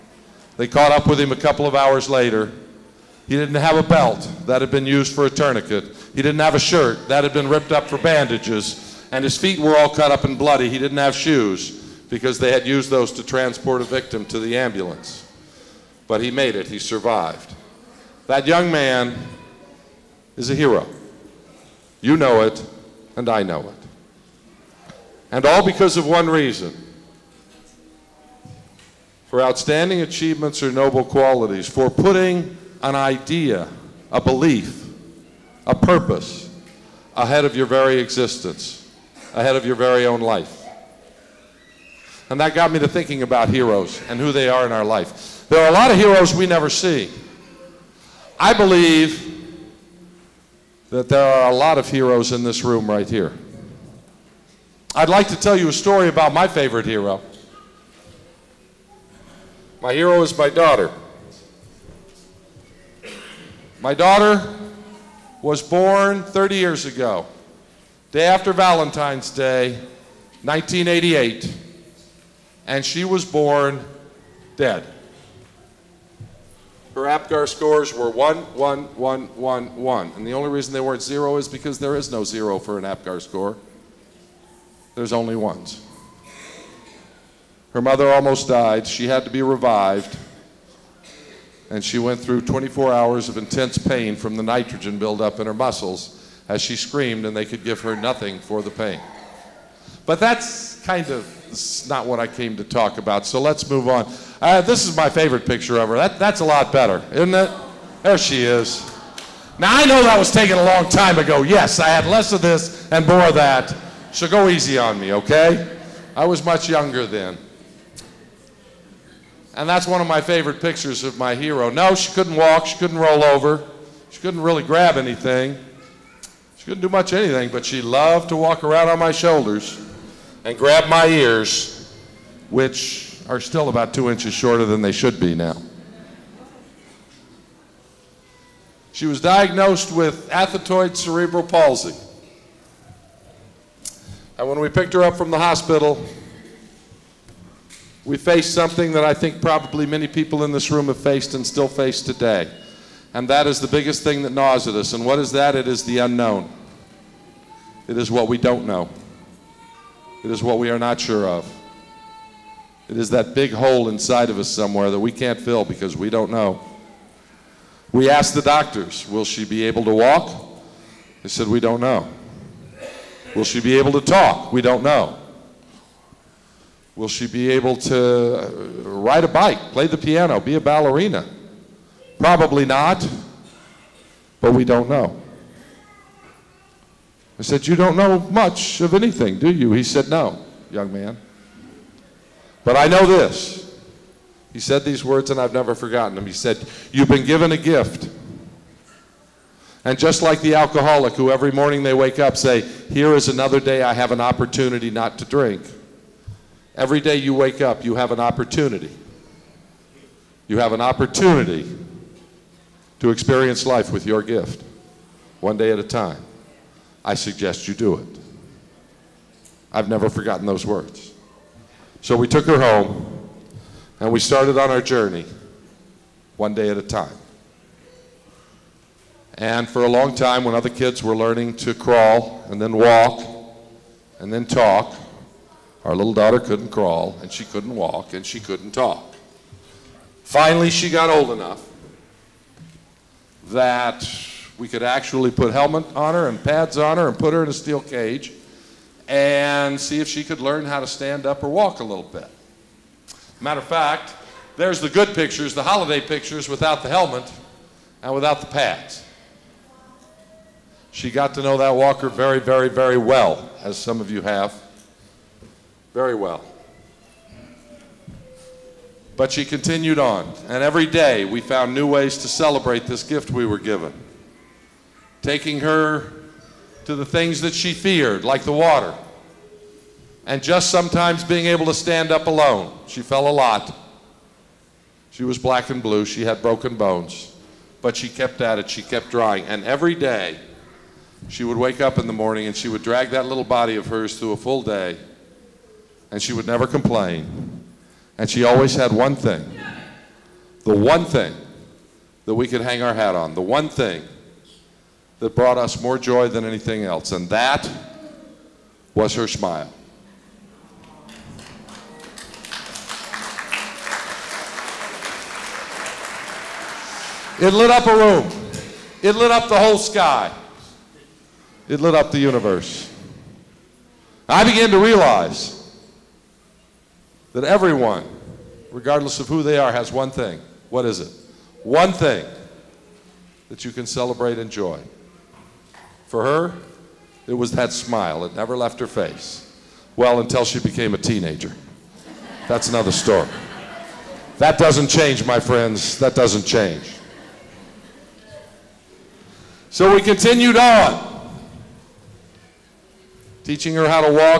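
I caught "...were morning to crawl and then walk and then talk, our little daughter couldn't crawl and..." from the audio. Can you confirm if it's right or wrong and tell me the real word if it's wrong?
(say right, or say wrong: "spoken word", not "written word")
wrong: "learning", not "morning".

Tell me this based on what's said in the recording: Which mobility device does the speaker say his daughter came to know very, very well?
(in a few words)
walker.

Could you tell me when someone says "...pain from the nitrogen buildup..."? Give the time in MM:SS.
01:33.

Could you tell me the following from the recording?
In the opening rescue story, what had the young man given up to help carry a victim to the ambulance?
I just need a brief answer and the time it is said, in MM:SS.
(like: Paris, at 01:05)
shoes, at 00:11.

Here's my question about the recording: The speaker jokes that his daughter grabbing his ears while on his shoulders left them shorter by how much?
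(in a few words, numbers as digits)
2 inches.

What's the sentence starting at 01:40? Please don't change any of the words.
But that's kind of it's not what I came to talk about.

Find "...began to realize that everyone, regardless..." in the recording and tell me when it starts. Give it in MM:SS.
05:24.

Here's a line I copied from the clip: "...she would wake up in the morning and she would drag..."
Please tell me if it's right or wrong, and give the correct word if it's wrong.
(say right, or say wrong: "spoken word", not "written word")
right.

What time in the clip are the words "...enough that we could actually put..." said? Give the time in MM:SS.
04:01.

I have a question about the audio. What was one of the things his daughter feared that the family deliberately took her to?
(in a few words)
the water.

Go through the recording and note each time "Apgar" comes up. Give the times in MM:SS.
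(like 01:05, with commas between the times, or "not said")
01:17, 01:22.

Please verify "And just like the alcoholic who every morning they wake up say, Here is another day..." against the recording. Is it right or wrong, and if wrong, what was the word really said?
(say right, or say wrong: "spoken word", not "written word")
right.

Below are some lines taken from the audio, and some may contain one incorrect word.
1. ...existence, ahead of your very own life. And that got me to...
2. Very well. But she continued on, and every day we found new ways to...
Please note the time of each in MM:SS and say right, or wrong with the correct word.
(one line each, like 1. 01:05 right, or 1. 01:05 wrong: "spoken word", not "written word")
1. 00:37 right
2. 04:25 right.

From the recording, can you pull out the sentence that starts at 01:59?
And that's one of my favorite pictures of my hero.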